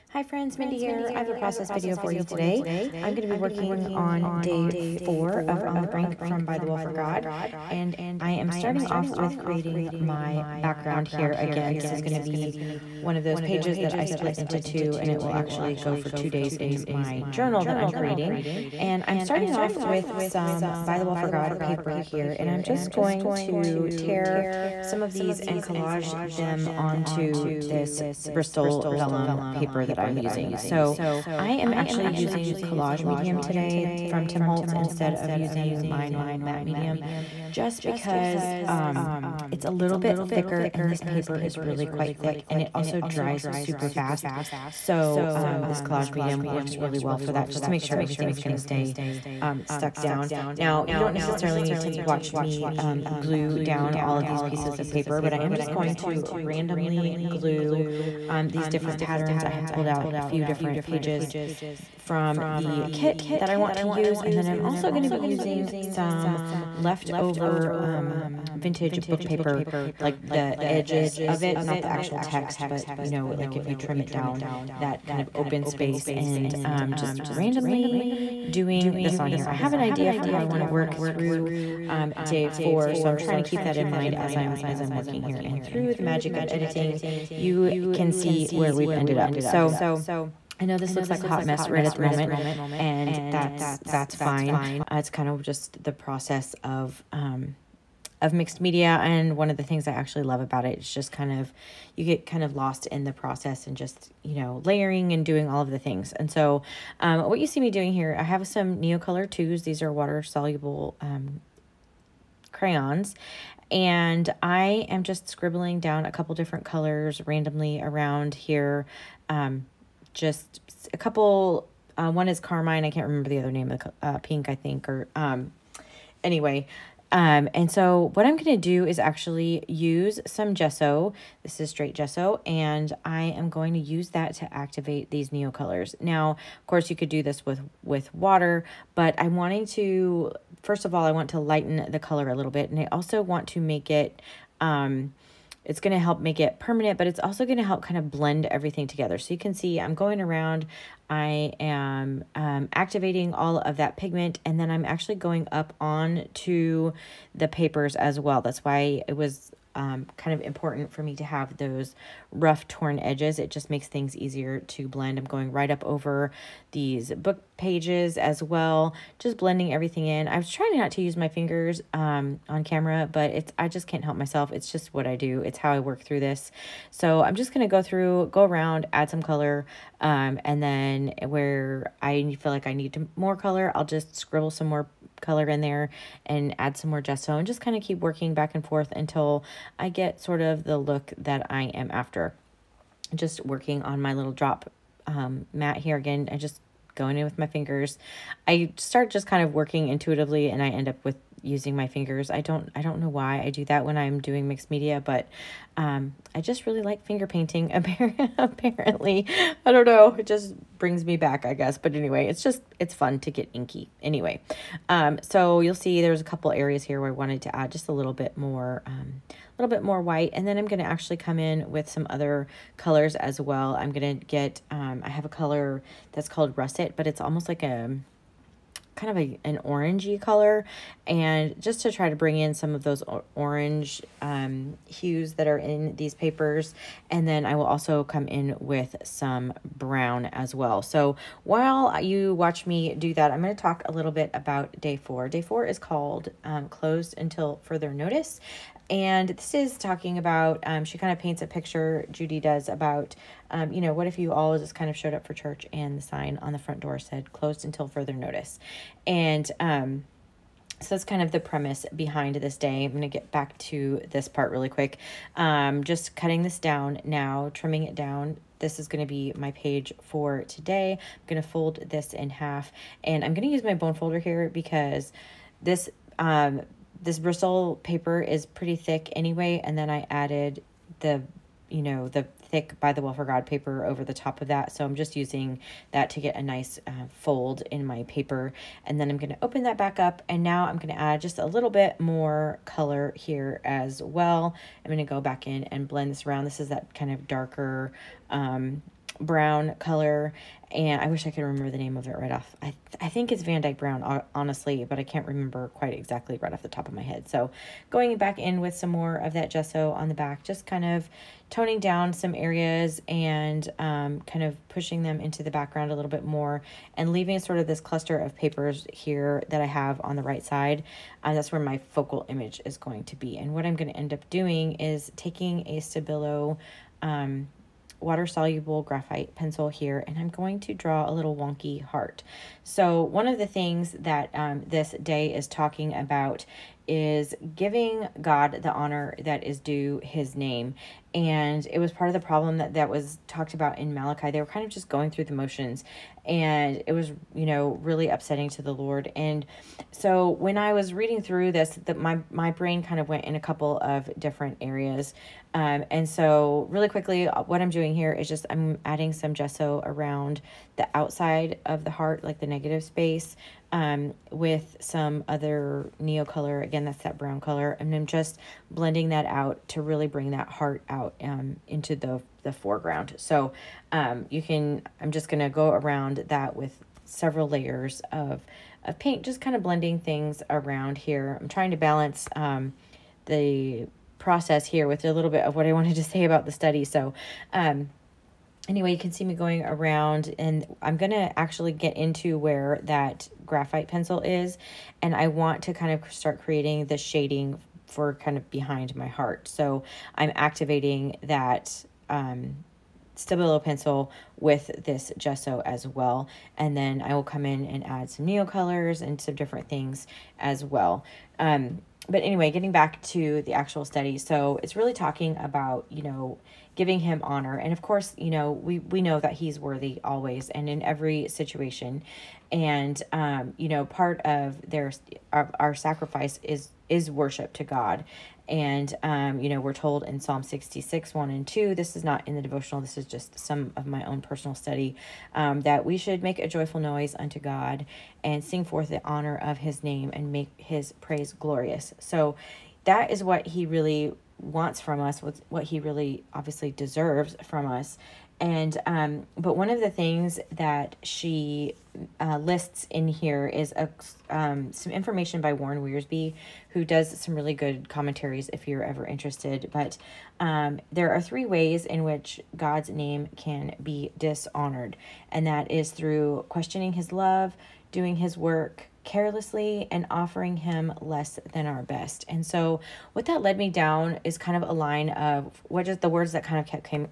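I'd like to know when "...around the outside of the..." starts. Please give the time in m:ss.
5:59.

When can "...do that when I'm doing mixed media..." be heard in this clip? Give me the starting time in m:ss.
3:23.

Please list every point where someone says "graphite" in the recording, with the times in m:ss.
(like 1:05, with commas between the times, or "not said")
5:28, 6:33.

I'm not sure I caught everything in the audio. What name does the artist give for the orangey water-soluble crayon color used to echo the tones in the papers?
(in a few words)
russet.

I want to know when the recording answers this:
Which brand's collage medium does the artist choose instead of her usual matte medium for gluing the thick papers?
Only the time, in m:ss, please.
0:34.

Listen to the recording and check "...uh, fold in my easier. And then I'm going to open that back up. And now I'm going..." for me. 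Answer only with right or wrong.
wrong.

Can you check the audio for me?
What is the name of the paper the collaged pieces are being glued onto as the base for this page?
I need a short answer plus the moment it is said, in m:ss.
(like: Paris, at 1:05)
Bristol vellum, at 0:28.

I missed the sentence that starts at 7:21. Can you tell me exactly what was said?
So that is what he really wants from us, what, what he really obviously deserves from us.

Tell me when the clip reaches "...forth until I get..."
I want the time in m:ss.
3:08.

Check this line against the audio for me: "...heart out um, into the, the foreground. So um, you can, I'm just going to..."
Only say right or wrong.
right.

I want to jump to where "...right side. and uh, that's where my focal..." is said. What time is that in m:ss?
5:20.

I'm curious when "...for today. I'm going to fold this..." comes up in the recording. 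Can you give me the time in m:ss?
4:30.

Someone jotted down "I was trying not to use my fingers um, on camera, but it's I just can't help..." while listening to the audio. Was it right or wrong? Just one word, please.
right.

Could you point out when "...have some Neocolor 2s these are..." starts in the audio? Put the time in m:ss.
1:48.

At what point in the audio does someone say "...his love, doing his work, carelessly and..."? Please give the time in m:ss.
7:46.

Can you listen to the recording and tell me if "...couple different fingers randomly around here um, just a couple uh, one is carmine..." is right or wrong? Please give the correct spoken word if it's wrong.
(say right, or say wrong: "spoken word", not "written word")
wrong: "colors", not "fingers".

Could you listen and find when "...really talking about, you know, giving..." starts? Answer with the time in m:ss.
6:54.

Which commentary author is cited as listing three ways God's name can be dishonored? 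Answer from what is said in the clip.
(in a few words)
Warren Wiersbe.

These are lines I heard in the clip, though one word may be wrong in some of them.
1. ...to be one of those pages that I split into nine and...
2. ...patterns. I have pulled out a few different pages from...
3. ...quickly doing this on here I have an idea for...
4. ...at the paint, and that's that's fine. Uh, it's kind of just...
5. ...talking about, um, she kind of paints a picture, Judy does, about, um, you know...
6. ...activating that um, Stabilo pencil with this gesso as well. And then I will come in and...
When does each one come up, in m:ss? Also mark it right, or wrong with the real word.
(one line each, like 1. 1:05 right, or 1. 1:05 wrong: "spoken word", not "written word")
1. 0:12 wrong: "two", not "nine"
2. 0:58 right
3. 1:17 wrong: "randomly", not "quickly"
4. 1:31 wrong: "moment", not "paint"
5. 4:09 right
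6. 6:40 right.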